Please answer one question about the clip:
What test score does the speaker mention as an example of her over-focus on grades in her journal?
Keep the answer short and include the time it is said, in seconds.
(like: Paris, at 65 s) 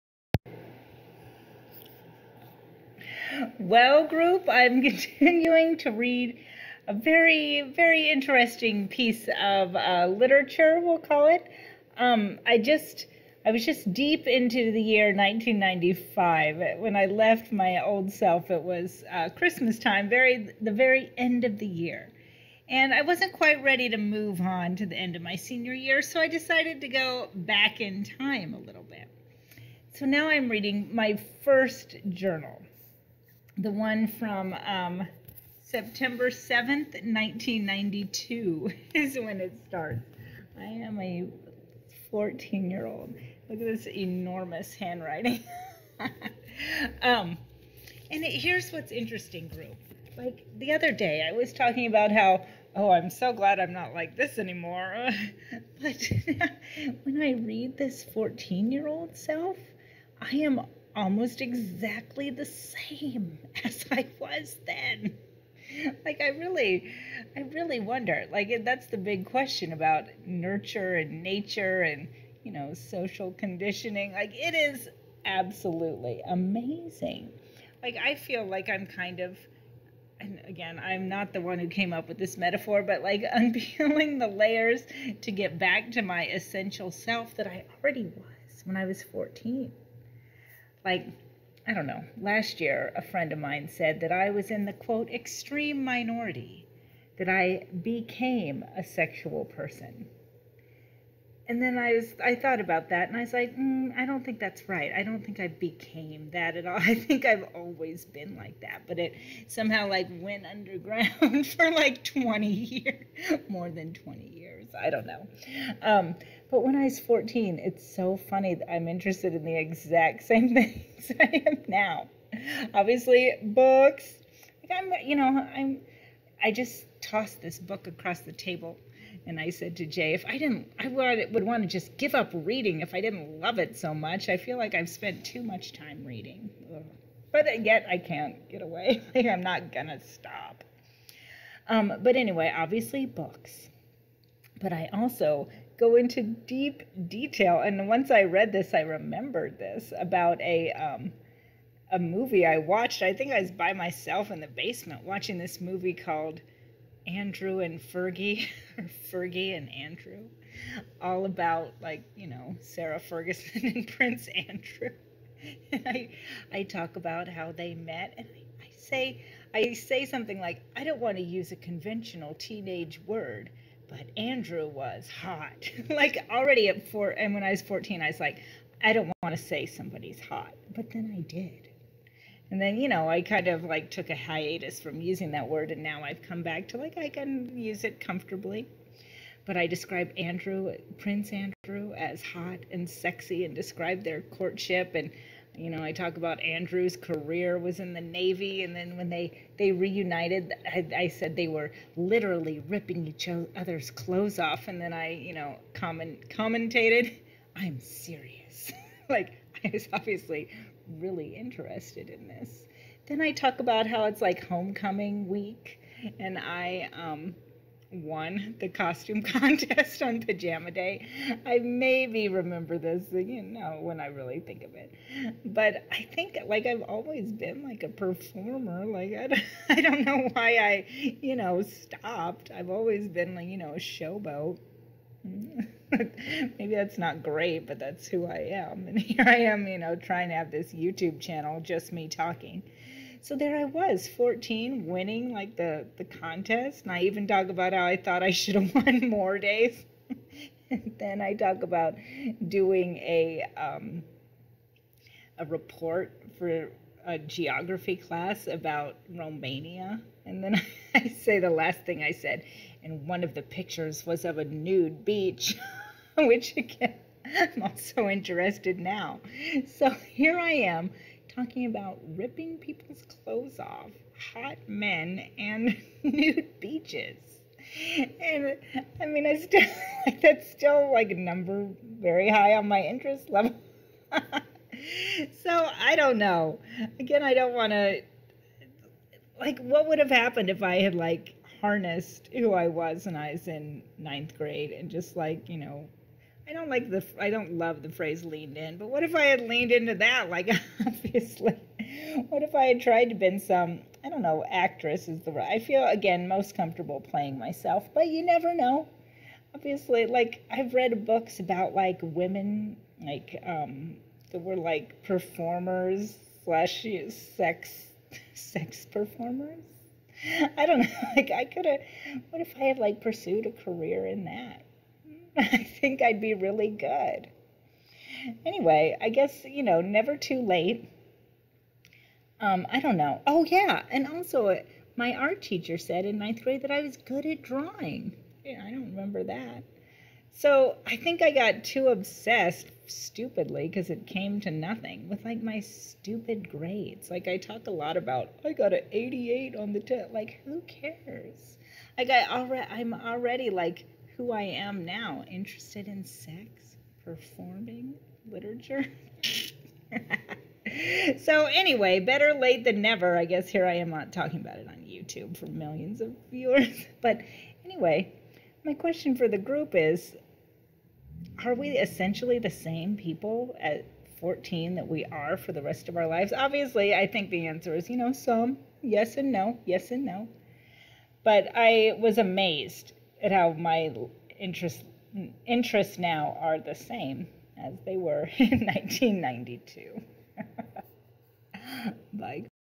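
88, at 348 s.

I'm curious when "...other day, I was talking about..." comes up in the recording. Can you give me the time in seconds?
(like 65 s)
50 s.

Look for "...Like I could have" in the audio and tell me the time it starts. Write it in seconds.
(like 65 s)
321 s.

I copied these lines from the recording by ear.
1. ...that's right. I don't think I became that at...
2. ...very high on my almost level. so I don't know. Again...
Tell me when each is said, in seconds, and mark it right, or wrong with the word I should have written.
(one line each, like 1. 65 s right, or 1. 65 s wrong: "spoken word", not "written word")
1. 104 s right
2. 281 s wrong: "interest", not "almost".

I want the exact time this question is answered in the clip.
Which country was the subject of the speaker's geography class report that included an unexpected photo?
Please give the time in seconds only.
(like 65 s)
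259 s.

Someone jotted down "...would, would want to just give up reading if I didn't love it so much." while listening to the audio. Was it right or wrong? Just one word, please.
right.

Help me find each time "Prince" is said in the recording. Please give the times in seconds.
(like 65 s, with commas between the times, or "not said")
163 s, 190 s.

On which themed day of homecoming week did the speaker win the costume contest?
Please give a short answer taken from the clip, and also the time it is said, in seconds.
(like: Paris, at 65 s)
Pajama day, at 220 s.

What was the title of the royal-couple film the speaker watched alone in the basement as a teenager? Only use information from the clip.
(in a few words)
Andrew and Fergie.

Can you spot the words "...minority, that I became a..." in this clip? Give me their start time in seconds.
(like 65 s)
95 s.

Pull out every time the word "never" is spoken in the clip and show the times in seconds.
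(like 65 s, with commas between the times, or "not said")
308 s, 329 s, 362 s.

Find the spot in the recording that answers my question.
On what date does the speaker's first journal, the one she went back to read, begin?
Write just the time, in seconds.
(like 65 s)
35 s.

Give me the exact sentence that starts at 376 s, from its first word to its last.
Obviously, I think the answer is, you know, some yes and no, yes and no.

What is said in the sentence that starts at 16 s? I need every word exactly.
When I left my old self, it was uh, Christmas time, very, the very end of the year.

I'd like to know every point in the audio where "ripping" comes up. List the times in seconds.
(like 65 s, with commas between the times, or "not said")
202 s, 272 s.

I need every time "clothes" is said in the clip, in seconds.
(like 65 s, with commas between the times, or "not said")
203 s, 273 s.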